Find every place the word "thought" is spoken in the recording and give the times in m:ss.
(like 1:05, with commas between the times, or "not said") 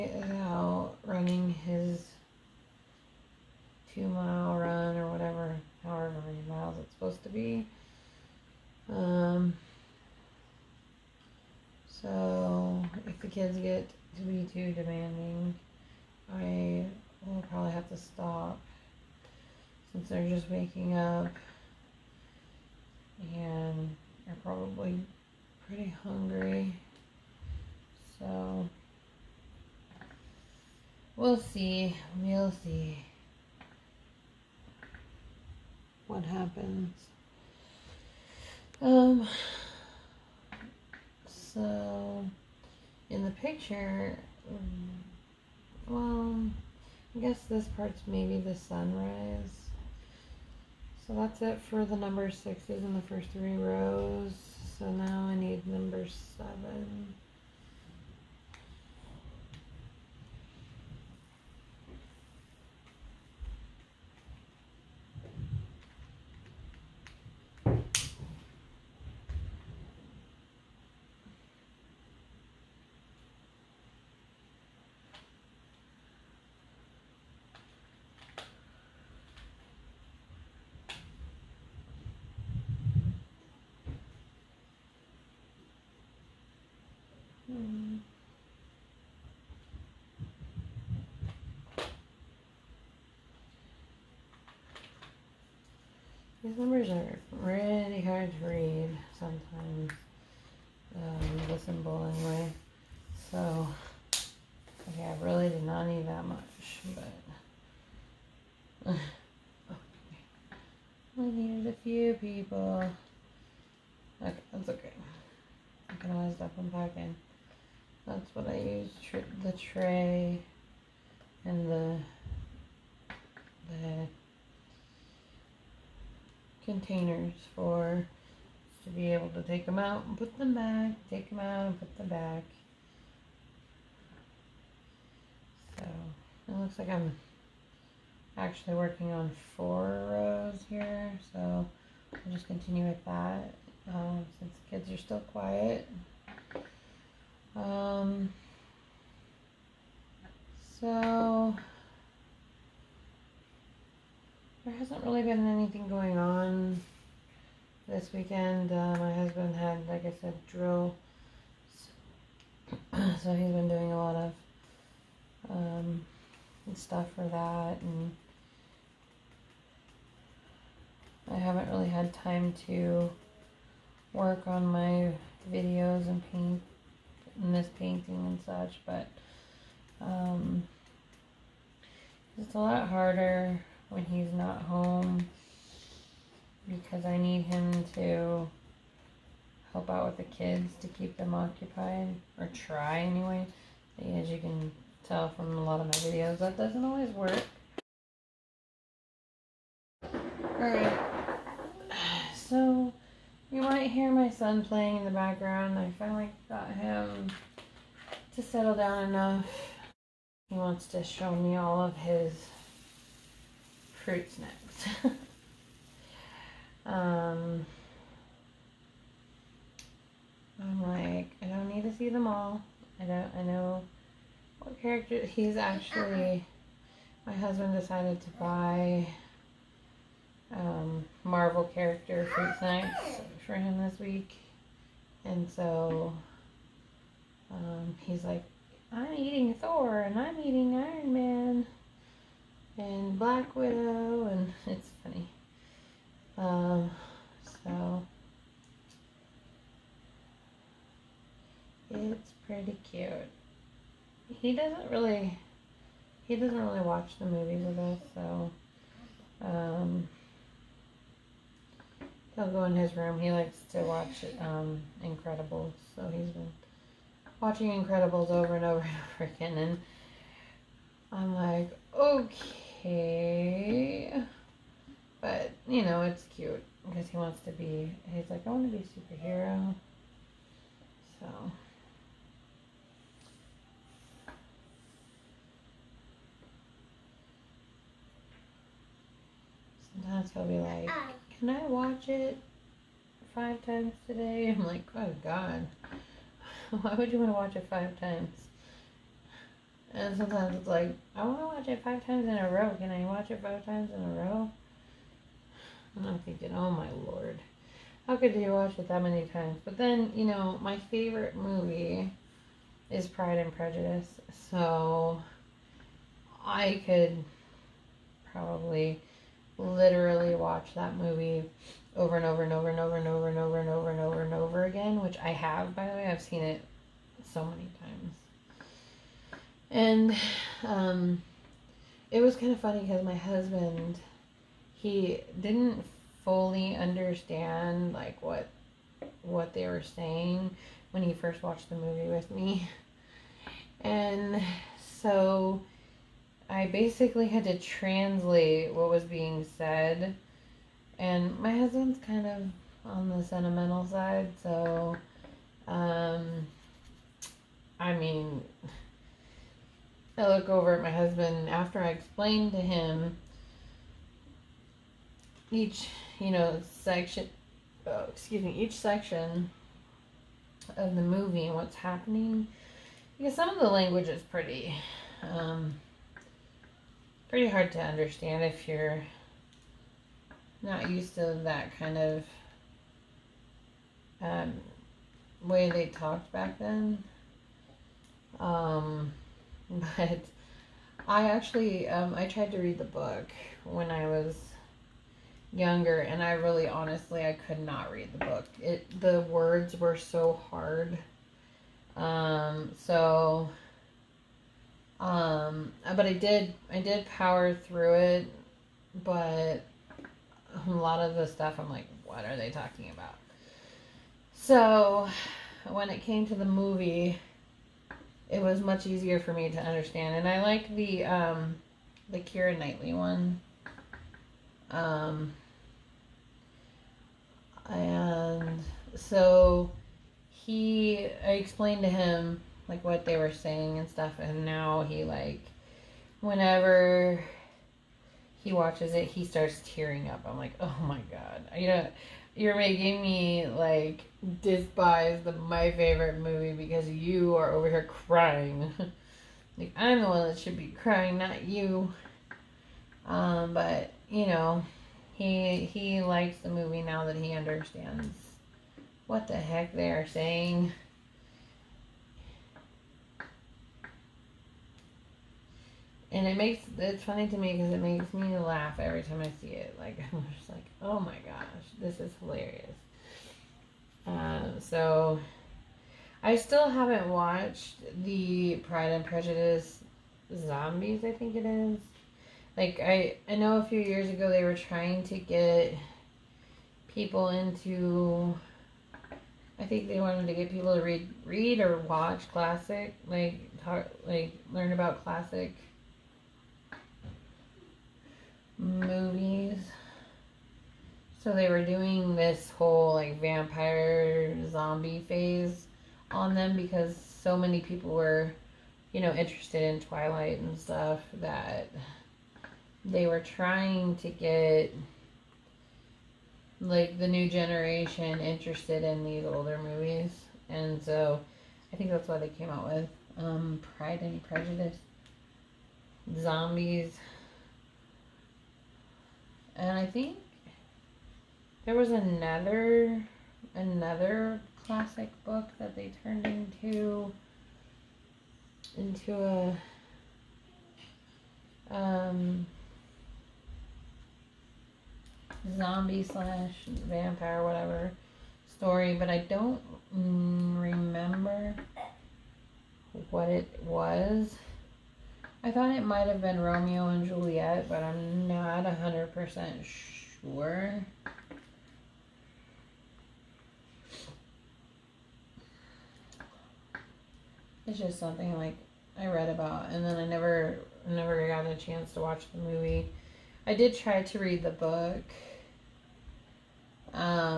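9:15.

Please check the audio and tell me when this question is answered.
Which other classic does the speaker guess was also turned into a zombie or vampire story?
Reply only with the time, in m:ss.
9:16.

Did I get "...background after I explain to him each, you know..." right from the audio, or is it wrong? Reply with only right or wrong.
wrong.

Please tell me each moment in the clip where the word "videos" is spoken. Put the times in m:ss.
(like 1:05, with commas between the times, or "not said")
2:55, 3:16.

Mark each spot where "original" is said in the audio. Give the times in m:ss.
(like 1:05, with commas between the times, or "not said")
not said.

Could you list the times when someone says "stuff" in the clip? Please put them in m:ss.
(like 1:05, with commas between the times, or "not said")
2:46, 6:51, 7:13, 8:30.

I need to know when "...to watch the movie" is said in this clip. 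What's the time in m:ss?
9:31.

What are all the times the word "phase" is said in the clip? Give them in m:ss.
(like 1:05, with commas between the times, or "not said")
8:25.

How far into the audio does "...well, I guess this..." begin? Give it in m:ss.
0:45.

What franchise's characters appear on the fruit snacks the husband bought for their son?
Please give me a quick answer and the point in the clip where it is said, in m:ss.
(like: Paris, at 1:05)
Marvel, at 3:51.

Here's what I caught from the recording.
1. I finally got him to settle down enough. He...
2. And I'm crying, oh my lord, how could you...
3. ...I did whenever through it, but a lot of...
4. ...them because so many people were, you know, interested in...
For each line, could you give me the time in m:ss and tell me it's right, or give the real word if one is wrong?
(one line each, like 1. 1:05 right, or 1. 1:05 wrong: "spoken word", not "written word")
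1. 3:25 right
2. 5:05 wrong: "thinking", not "crying"
3. 6:46 wrong: "power", not "whenever"
4. 8:26 right.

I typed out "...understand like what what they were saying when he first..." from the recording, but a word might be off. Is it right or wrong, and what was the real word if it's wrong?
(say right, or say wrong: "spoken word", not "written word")
right.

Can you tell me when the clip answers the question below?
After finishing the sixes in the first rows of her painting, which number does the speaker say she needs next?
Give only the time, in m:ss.
0:55.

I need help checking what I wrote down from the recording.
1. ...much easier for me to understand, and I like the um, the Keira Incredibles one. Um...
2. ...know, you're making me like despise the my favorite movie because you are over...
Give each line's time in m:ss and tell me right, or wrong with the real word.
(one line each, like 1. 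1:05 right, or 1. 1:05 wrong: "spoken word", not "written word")
1. 6:58 wrong: "Knightley", not "Incredibles"
2. 7:21 right.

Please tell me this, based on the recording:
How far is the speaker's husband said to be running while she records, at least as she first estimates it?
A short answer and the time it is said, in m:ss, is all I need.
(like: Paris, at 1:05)
2 miles, at 0:03.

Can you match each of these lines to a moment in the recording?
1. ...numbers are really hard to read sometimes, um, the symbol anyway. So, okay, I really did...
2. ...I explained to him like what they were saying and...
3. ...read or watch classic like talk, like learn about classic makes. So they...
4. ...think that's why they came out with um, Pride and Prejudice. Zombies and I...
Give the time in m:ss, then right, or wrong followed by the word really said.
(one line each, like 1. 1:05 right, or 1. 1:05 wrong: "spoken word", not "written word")
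1. 1:36 right
2. 7:11 right
3. 8:11 wrong: "movies", not "makes"
4. 8:41 right.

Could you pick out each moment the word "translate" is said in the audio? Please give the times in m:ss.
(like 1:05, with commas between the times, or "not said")
5:47.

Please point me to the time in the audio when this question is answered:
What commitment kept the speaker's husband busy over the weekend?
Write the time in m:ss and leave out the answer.
2:40.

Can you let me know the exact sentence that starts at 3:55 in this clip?
And so um, he's like, I'm eating Thor and I'm eating Iron Man and Black Widow.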